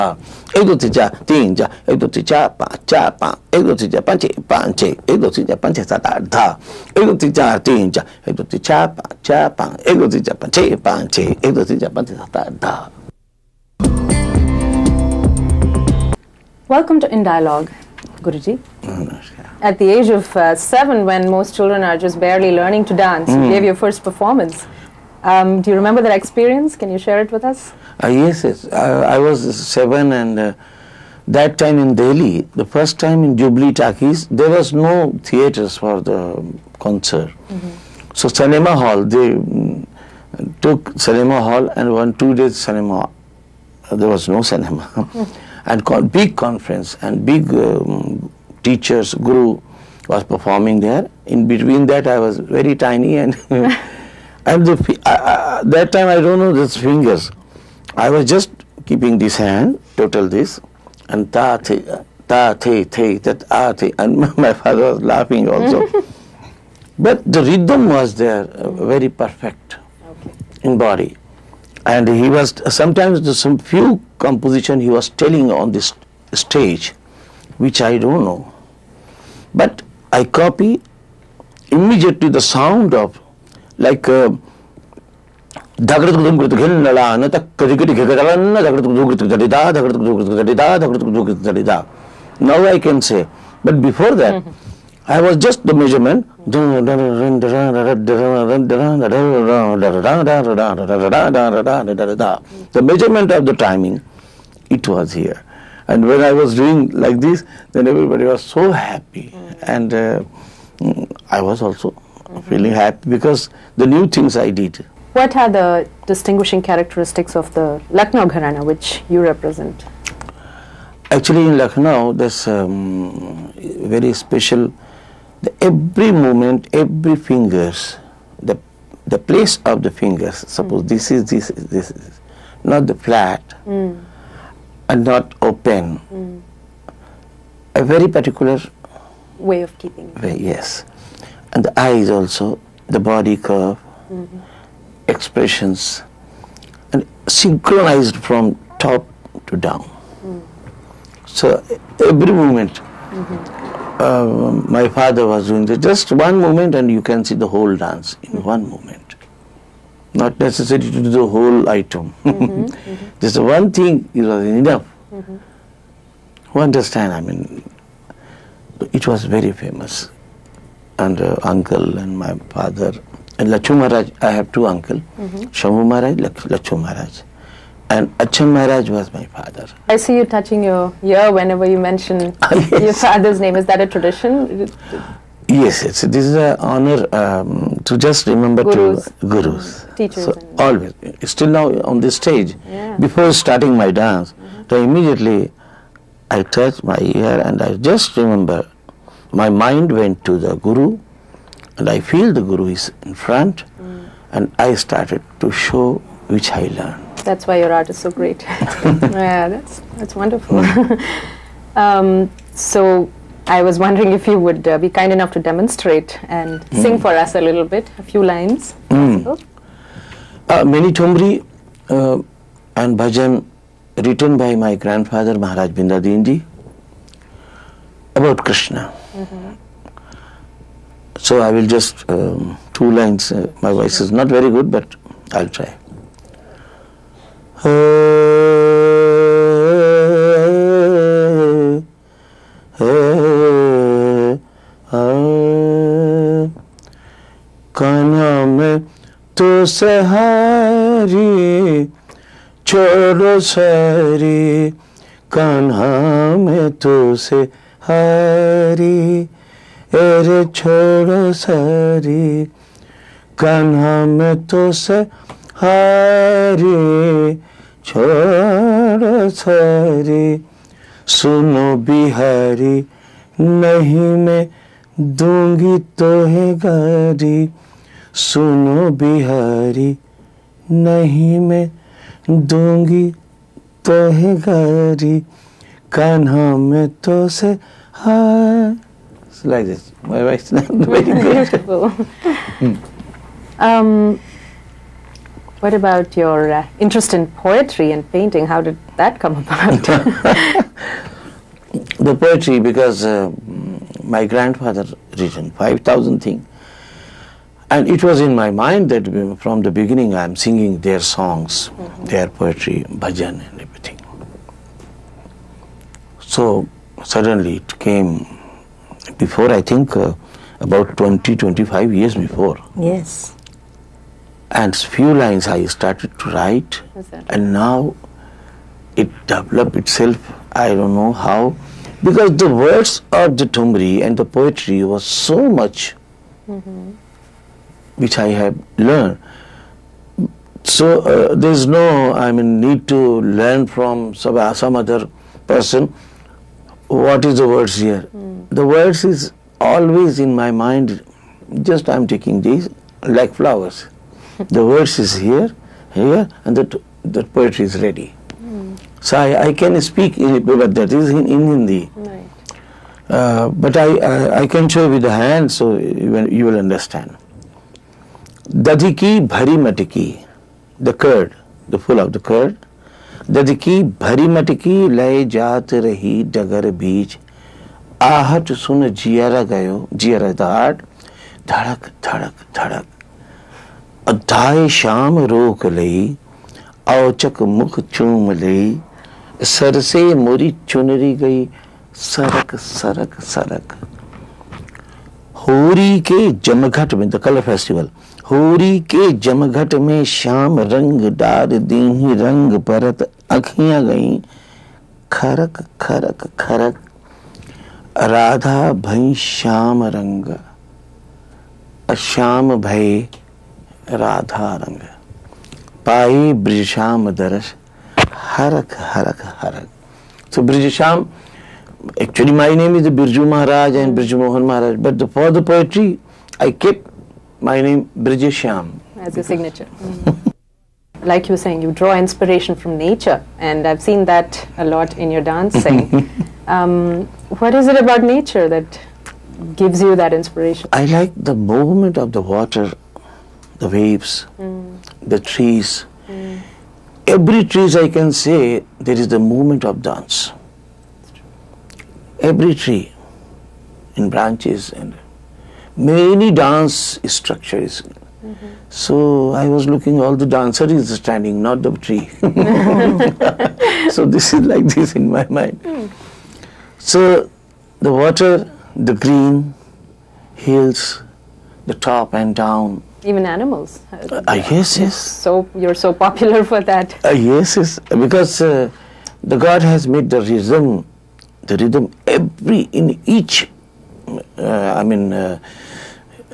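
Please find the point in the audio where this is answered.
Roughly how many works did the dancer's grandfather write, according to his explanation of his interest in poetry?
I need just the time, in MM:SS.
05:05.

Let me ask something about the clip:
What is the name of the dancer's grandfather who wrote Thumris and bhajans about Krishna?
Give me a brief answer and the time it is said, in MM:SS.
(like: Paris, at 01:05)
Maharaj Bindadinji, at 03:45.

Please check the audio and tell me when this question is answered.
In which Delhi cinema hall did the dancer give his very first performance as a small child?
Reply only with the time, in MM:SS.
00:33.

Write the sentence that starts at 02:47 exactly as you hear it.
I mean, it was very famous.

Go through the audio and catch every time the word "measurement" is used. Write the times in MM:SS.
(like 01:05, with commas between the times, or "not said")
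01:35, 01:42.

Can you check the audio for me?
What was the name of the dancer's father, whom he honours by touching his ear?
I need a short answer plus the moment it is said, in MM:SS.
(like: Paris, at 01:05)
Achan Maharaj, at 02:58.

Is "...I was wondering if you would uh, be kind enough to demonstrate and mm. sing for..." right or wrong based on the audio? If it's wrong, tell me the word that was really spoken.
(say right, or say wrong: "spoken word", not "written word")
right.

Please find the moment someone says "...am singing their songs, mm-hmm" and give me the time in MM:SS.
05:10.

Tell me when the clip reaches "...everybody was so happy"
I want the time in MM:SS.
01:47.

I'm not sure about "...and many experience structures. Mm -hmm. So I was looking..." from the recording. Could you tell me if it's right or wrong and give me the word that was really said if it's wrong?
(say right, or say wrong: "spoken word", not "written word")
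wrong: "dance", not "experience".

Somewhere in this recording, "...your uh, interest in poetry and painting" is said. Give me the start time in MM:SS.
04:56.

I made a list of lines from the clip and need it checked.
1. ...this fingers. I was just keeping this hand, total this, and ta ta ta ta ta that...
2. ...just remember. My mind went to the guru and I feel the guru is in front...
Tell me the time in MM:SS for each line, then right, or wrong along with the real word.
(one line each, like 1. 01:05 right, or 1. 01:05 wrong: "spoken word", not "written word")
1. 00:56 right
2. 03:17 right.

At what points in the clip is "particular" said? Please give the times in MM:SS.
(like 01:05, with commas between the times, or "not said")
02:18.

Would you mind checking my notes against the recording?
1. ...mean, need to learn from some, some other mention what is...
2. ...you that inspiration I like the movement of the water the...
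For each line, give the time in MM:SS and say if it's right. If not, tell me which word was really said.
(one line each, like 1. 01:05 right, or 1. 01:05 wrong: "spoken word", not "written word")
1. 05:42 wrong: "person", not "mention"
2. 07:19 right.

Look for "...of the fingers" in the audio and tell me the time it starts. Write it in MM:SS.
02:09.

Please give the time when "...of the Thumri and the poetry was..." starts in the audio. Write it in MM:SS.
05:33.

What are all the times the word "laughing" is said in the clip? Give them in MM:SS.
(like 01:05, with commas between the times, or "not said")
01:05.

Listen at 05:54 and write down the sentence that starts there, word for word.
The verse is here, here, and that, that poetry is ready.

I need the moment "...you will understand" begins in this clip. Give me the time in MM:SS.
06:06.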